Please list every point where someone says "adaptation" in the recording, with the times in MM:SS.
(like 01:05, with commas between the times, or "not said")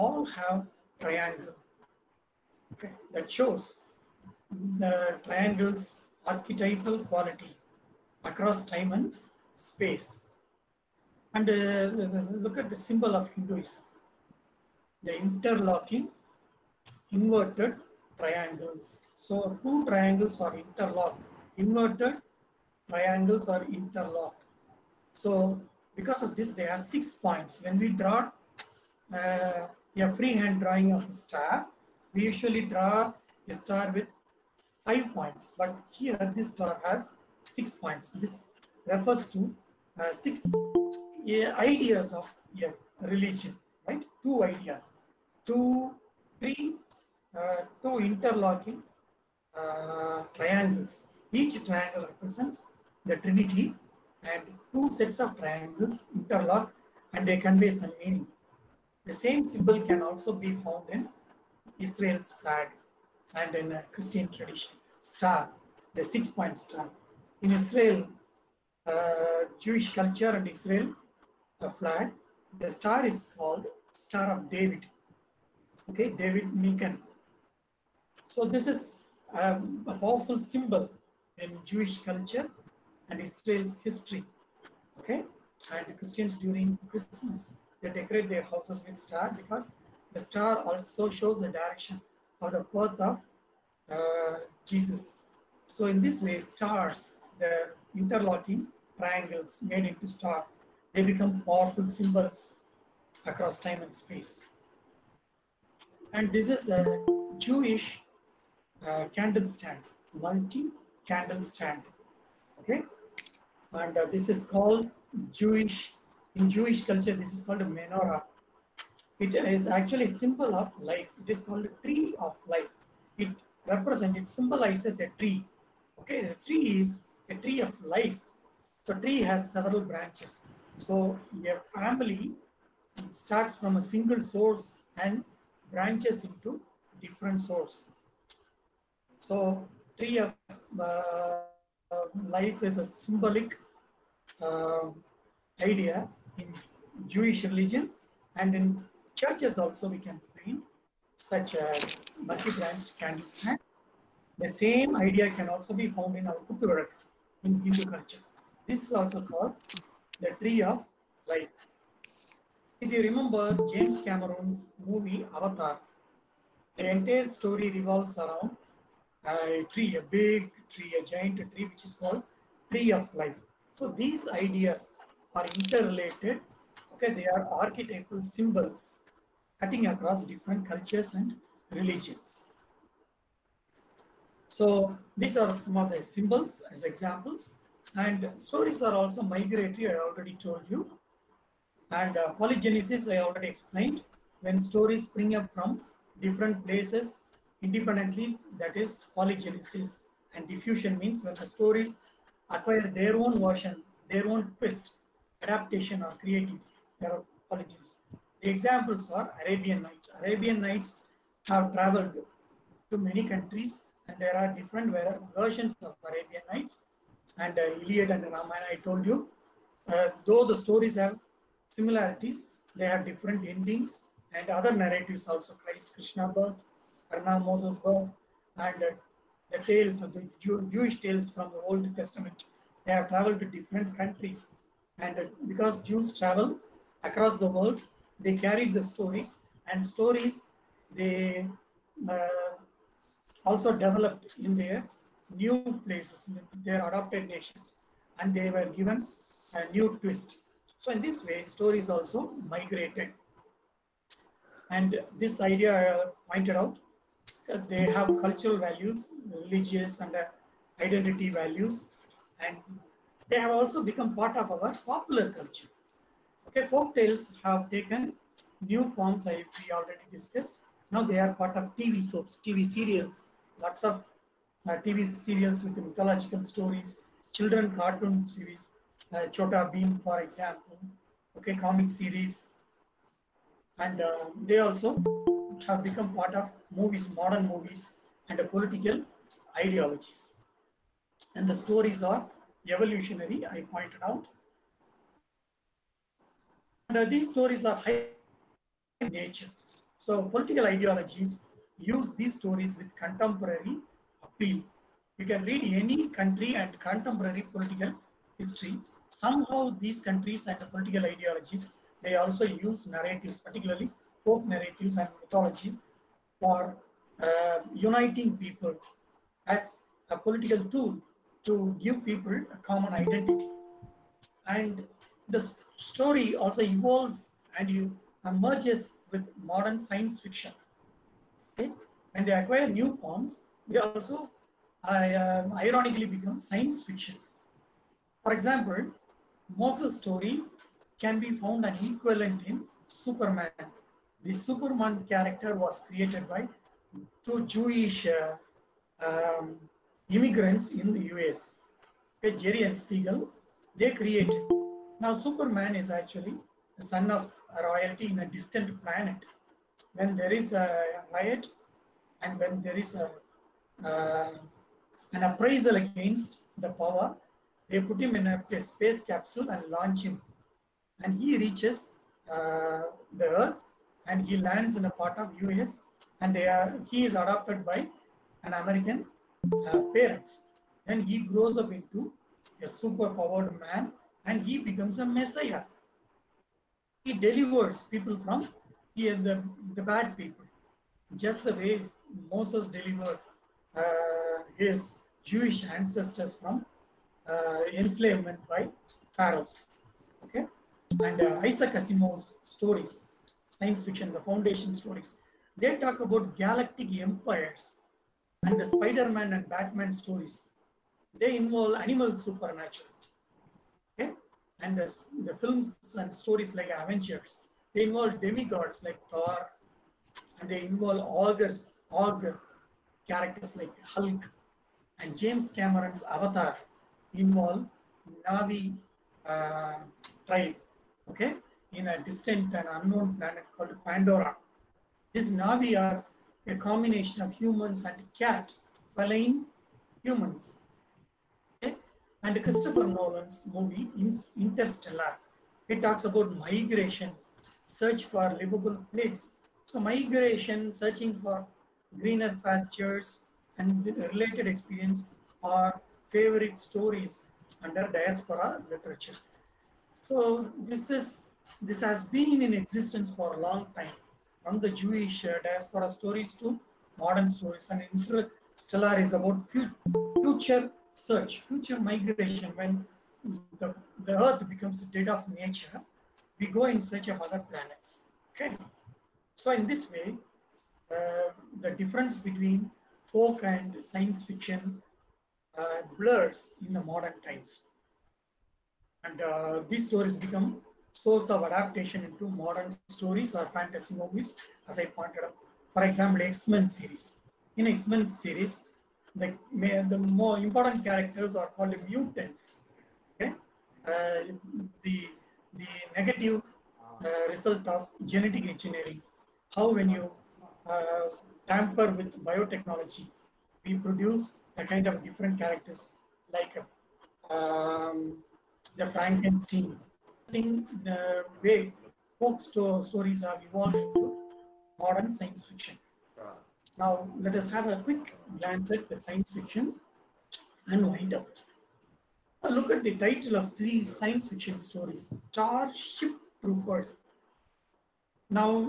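03:25, 08:11.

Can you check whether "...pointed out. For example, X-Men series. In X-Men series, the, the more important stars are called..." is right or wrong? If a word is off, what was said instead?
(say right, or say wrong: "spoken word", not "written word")
wrong: "characters", not "stars".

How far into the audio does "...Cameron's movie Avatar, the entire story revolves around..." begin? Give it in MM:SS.
02:44.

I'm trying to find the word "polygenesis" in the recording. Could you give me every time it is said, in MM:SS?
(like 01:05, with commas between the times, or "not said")
03:12, 03:19, 03:27.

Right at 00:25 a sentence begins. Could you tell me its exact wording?
So because of this, there are six points.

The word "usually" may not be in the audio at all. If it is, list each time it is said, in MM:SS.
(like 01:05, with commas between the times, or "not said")
00:32.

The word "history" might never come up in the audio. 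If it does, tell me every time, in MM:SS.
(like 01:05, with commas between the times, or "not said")
01:23, 05:08.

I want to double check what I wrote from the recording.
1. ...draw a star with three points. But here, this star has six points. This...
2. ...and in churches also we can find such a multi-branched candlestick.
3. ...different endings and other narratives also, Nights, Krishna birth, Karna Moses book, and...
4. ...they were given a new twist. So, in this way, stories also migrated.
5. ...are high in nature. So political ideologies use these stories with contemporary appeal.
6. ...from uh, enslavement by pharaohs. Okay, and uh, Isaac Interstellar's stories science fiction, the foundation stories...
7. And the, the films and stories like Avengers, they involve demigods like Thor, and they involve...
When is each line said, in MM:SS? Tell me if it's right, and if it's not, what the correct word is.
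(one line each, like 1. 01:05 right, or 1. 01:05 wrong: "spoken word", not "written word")
1. 00:32 wrong: "five", not "three"
2. 02:28 right
3. 03:43 wrong: "Christ", not "Nights"
4. 04:08 right
5. 04:57 right
6. 06:36 wrong: "Asimov", not "Interstellar"
7. 06:54 right.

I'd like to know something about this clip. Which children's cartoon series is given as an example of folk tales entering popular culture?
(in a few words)
Chhota Bheem.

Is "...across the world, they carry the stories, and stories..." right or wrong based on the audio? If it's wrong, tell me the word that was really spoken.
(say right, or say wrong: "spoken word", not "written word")
right.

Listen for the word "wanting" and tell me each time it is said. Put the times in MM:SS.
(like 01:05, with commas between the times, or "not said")
not said.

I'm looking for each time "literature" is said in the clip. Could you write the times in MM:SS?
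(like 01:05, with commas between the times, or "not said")
07:38.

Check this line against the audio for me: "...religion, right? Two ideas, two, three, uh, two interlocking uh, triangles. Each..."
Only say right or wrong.
right.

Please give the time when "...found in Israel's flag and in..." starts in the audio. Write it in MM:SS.
01:00.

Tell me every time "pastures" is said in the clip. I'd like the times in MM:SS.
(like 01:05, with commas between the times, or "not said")
07:32.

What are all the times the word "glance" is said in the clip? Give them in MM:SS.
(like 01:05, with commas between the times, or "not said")
08:48.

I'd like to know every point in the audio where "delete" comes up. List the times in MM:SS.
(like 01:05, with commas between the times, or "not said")
not said.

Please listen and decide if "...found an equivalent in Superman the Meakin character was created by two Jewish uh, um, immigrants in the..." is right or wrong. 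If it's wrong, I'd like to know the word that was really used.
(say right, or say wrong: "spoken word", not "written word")
wrong: "Superman", not "Meakin".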